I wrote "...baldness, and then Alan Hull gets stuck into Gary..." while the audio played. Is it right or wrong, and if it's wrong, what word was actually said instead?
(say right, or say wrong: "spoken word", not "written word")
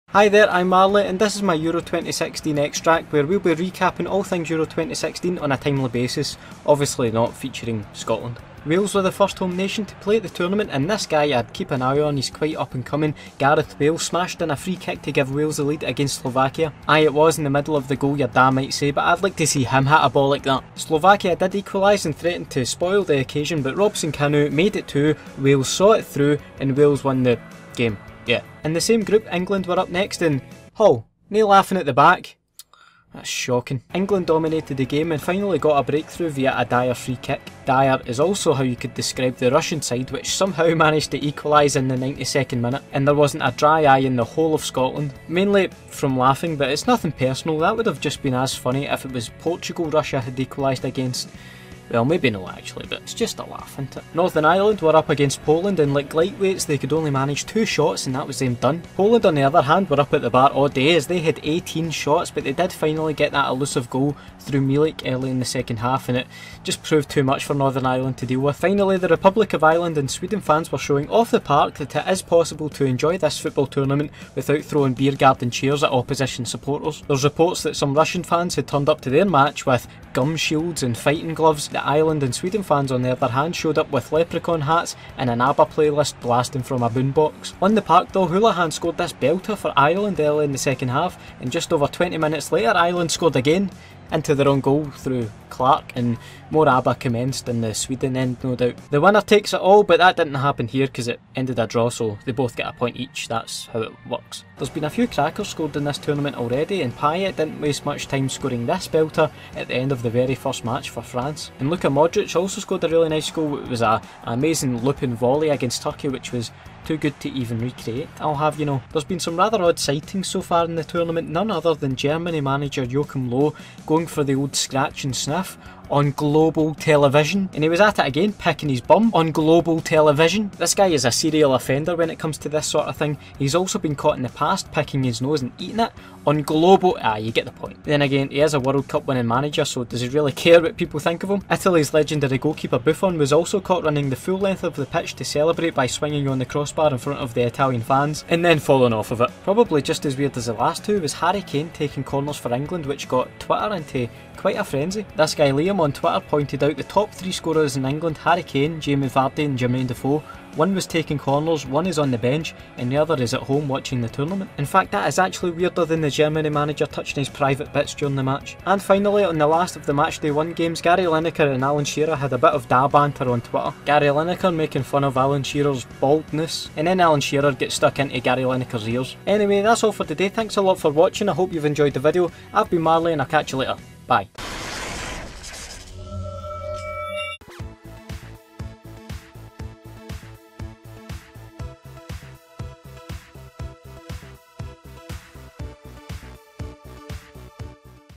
wrong: "Shearer", not "Hull".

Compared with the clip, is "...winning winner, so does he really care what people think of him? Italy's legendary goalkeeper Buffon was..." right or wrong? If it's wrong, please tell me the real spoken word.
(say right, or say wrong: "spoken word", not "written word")
wrong: "manager", not "winner".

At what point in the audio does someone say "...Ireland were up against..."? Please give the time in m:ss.
0:54.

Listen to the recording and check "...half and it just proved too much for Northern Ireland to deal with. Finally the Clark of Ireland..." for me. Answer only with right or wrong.
wrong.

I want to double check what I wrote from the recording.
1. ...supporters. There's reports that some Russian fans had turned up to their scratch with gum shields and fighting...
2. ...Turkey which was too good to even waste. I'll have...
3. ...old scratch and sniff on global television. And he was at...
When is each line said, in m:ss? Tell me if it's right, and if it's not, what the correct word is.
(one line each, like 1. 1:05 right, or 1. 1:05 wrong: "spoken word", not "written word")
1. 1:16 wrong: "match", not "scratch"
2. 1:55 wrong: "recreate", not "waste"
3. 2:04 right.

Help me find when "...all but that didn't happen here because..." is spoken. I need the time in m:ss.
1:39.